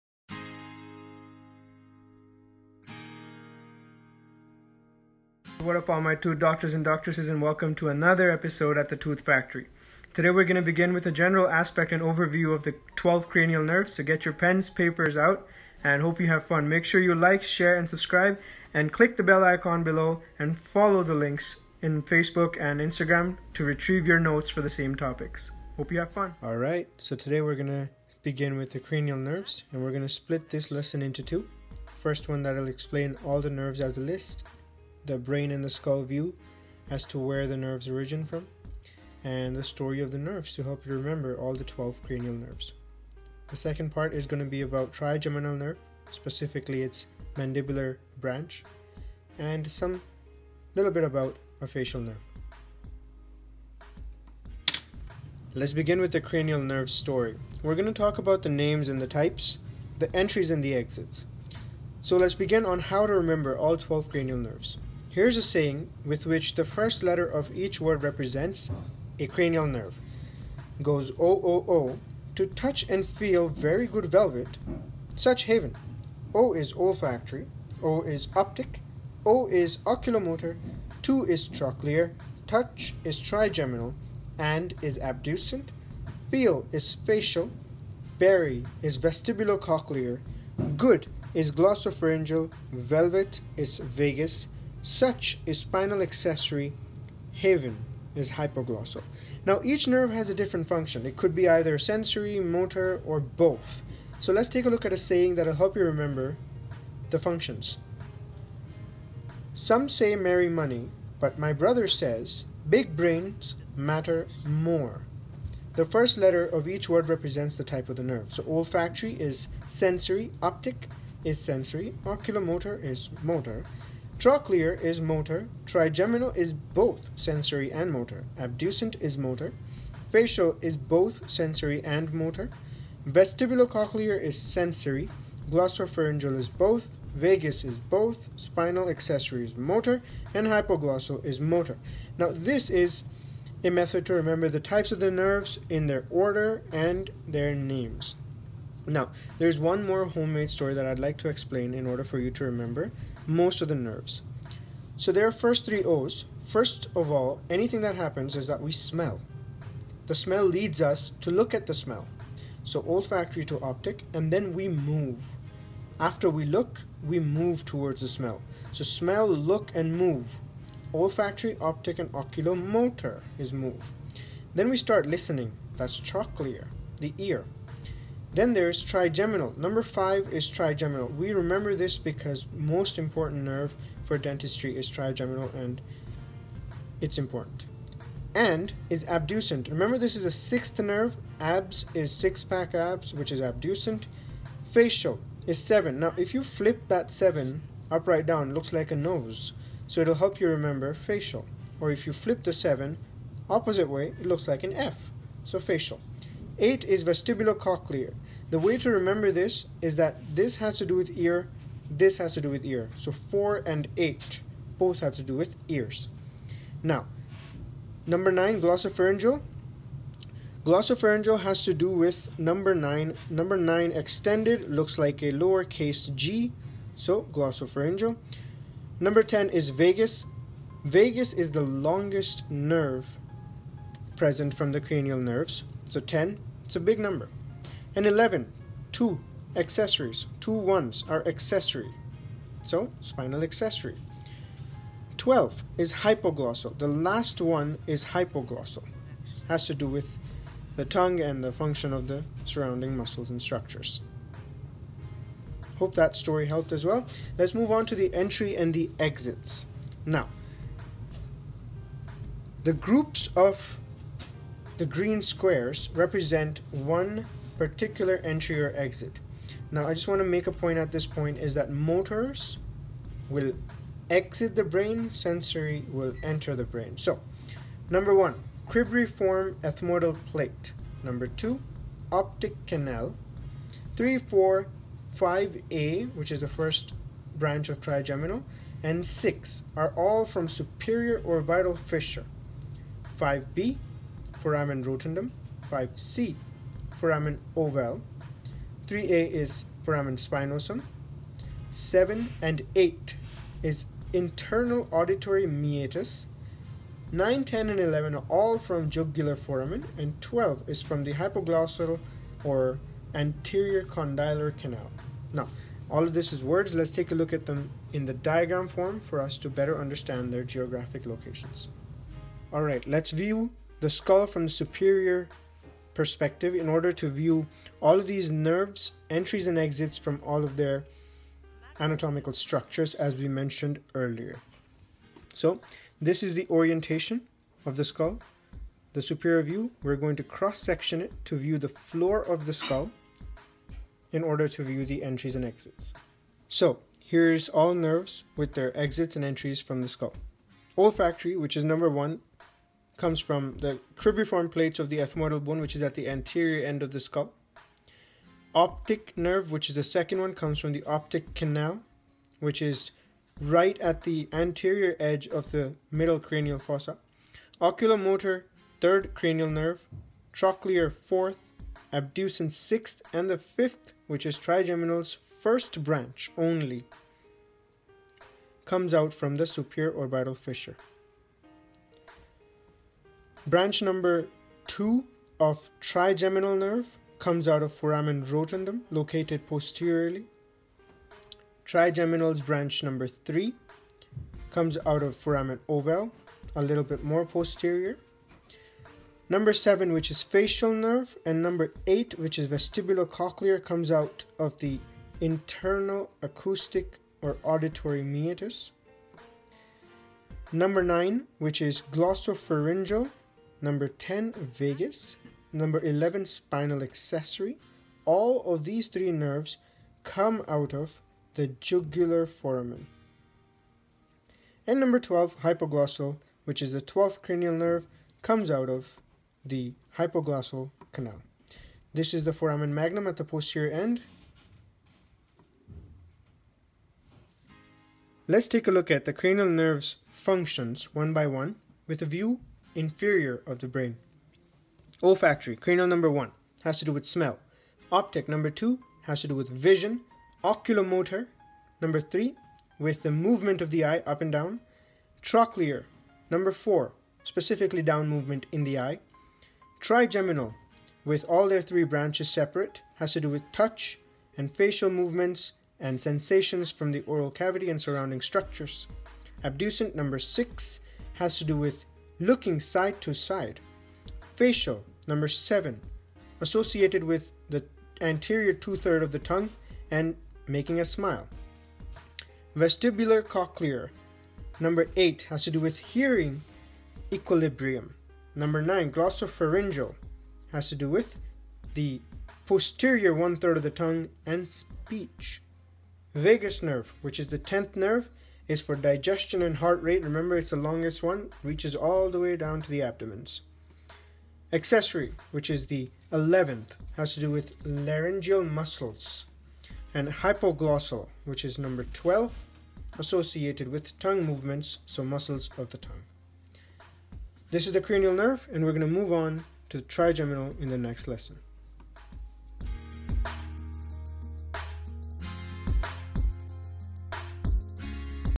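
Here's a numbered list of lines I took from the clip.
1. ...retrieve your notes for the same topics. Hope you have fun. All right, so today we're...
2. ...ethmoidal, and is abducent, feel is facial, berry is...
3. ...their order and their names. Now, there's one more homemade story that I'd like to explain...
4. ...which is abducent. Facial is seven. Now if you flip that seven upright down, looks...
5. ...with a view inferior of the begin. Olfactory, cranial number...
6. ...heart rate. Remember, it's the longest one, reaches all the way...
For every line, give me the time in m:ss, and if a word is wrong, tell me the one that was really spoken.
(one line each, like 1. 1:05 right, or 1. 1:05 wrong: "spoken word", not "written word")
1. 0:23 right
2. 1:23 wrong: "trigeminal", not "ethmoidal"
3. 2:25 right
4. 3:13 right
5. 7:21 wrong: "brain", not "begin"
6. 8:19 right.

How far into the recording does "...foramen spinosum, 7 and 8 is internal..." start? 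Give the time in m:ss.
4:59.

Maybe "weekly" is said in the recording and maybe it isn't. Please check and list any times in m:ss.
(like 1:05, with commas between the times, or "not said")
not said.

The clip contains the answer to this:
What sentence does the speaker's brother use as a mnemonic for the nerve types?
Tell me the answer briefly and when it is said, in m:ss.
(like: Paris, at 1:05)
Big brains matter more, at 1:52.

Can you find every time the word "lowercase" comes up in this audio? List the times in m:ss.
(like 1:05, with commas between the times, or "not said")
3:45.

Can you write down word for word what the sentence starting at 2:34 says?
So there are first three O's.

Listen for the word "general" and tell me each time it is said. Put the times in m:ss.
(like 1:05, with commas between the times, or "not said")
0:11.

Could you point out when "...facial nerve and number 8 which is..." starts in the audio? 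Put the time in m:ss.
6:40.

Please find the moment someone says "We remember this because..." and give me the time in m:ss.
3:01.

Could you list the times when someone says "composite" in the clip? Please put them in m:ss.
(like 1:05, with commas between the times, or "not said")
not said.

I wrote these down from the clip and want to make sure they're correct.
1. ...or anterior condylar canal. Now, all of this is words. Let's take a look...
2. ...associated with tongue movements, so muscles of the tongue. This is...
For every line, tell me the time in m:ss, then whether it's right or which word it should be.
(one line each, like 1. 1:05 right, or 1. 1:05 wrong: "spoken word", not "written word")
1. 5:12 right
2. 8:32 right.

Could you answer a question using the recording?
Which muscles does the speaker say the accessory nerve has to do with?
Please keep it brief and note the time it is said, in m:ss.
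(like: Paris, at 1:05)
Laryngeal muscles, at 8:27.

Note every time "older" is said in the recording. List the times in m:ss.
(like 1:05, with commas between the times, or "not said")
not said.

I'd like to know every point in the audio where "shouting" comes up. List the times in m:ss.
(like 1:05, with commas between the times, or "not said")
not said.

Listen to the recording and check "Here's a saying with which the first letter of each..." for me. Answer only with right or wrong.
right.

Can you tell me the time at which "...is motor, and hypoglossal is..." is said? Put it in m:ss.
2:19.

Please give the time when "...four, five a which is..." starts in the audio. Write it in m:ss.
4:44.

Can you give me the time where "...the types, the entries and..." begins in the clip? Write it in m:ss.
0:59.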